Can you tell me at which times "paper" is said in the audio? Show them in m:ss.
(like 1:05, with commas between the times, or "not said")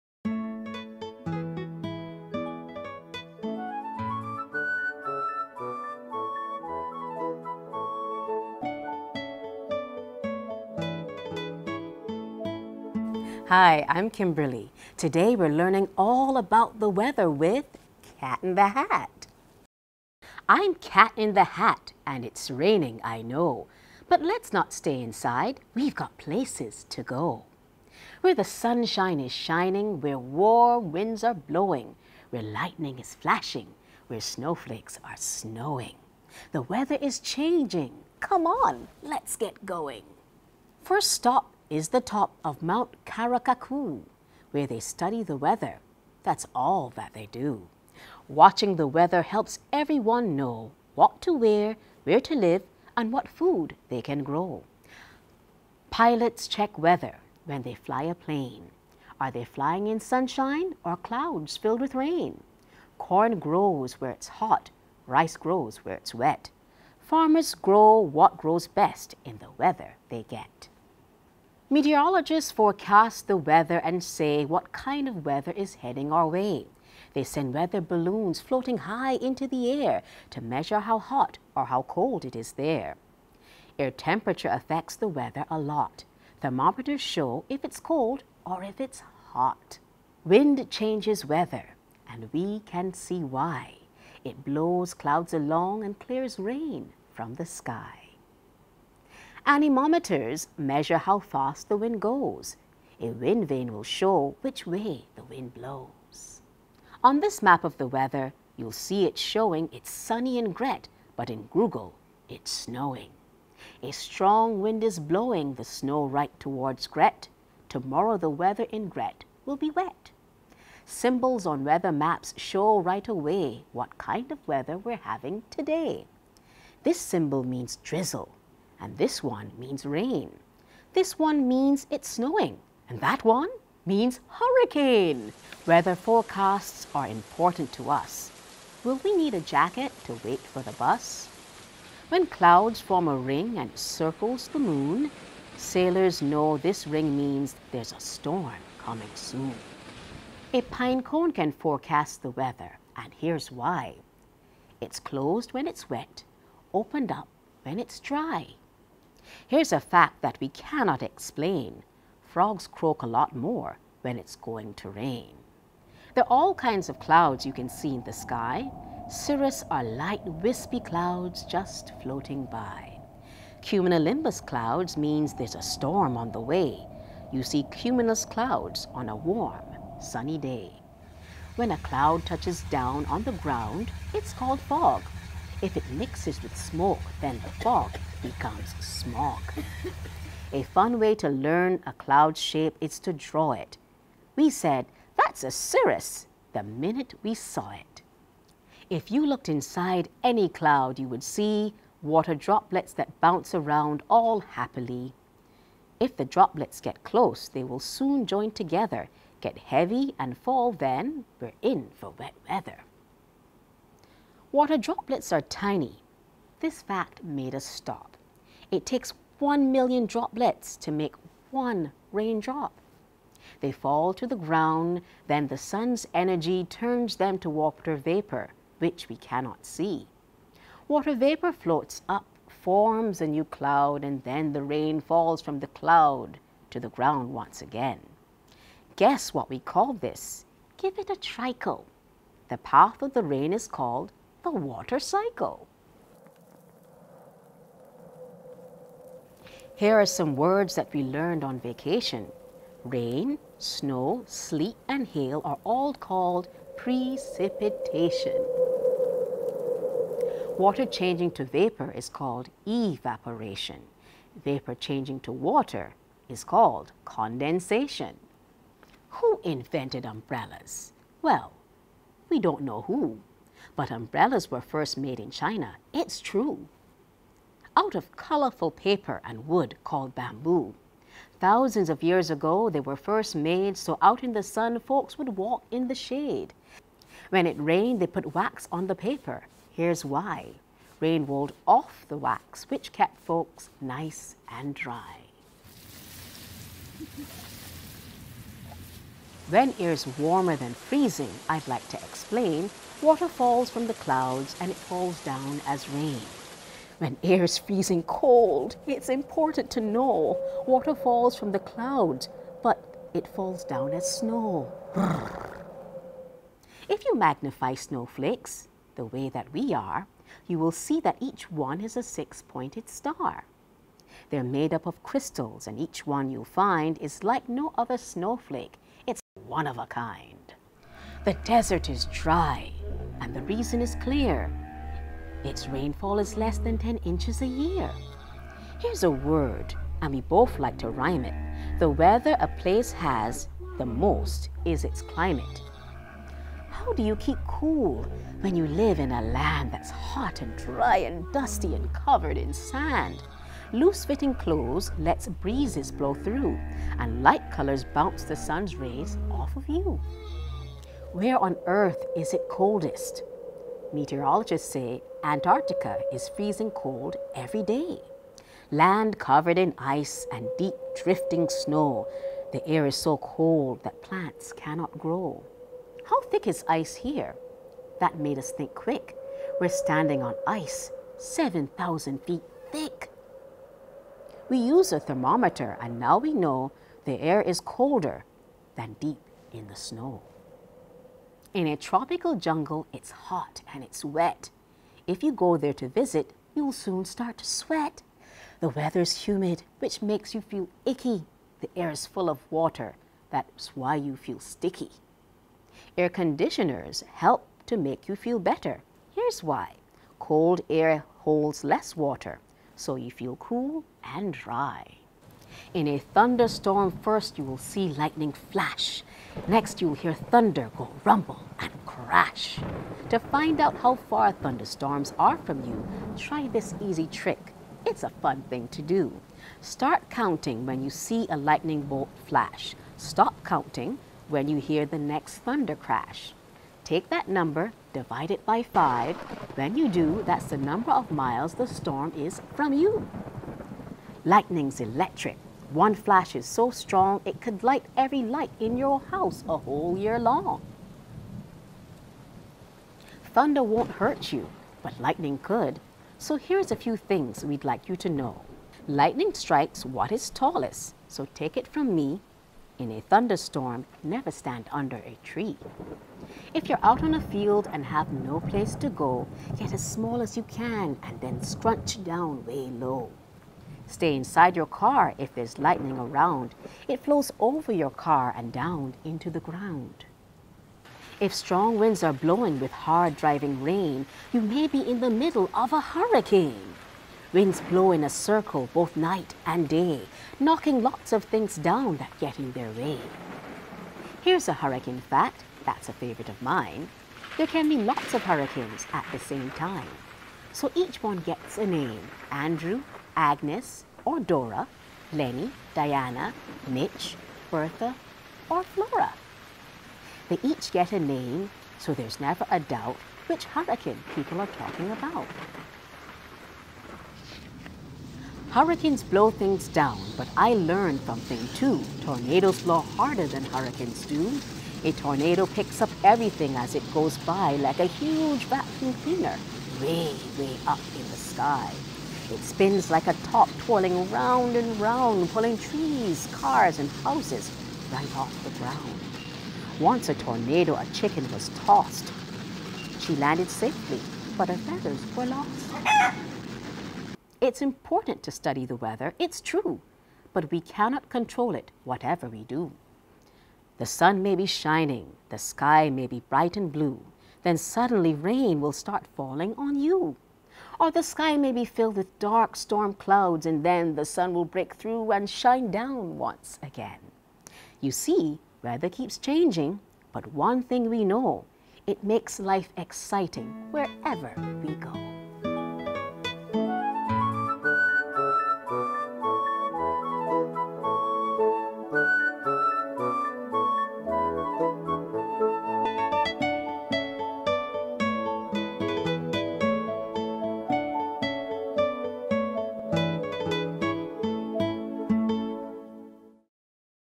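4:38, 4:48.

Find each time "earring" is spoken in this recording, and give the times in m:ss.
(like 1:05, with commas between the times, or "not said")
not said.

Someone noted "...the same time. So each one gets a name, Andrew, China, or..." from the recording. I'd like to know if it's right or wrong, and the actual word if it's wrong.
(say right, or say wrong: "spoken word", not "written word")
wrong: "Agnes", not "China".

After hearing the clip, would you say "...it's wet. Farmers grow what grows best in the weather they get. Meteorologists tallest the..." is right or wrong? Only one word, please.
wrong.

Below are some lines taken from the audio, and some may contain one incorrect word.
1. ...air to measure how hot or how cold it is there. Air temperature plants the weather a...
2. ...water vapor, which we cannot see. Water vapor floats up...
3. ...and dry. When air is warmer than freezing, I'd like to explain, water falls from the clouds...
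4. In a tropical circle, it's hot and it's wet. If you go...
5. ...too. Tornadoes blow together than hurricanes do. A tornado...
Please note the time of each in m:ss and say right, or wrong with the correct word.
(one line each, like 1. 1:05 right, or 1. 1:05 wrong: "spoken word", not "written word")
1. 1:19 wrong: "affects", not "plants"
2. 3:47 right
3. 4:54 right
4. 6:31 wrong: "jungle", not "circle"
5. 8:41 wrong: "harder", not "together".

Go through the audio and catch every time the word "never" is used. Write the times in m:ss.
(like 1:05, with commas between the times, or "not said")
7:44, 8:32.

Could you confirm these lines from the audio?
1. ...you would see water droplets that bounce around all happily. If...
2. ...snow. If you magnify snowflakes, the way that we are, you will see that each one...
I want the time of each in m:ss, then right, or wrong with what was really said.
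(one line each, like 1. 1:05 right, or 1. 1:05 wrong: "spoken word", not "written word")
1. 3:20 right
2. 5:14 right.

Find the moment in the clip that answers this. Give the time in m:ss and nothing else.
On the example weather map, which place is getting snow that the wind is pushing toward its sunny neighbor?
1:51.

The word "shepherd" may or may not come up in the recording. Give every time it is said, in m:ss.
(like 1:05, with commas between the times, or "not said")
not said.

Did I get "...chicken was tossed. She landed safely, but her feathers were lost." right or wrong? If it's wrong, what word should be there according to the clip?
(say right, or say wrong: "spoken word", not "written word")
right.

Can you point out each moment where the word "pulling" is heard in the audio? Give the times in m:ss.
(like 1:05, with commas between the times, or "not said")
8:55.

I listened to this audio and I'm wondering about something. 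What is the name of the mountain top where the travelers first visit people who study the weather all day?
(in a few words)
Mount Karakaku.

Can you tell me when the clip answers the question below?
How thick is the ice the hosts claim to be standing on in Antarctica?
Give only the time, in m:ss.
6:21.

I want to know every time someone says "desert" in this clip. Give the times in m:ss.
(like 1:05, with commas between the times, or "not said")
5:31.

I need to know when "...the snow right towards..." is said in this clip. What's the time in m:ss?
1:55.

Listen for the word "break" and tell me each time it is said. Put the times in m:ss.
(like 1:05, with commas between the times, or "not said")
9:24.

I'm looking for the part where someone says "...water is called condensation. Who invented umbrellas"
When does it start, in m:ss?
4:25.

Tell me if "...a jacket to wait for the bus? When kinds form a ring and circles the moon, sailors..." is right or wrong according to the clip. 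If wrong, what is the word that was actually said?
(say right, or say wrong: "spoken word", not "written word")
wrong: "clouds", not "kinds".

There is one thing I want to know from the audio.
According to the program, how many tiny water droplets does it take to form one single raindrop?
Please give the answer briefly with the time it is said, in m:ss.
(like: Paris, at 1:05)
1,000,000, at 3:39.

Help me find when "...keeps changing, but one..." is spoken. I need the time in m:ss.
9:28.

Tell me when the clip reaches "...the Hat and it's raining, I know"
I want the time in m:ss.
0:21.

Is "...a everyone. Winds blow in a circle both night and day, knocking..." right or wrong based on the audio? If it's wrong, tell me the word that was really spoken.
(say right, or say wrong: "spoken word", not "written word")
wrong: "hurricane", not "everyone".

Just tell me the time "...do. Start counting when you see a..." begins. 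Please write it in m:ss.
7:08.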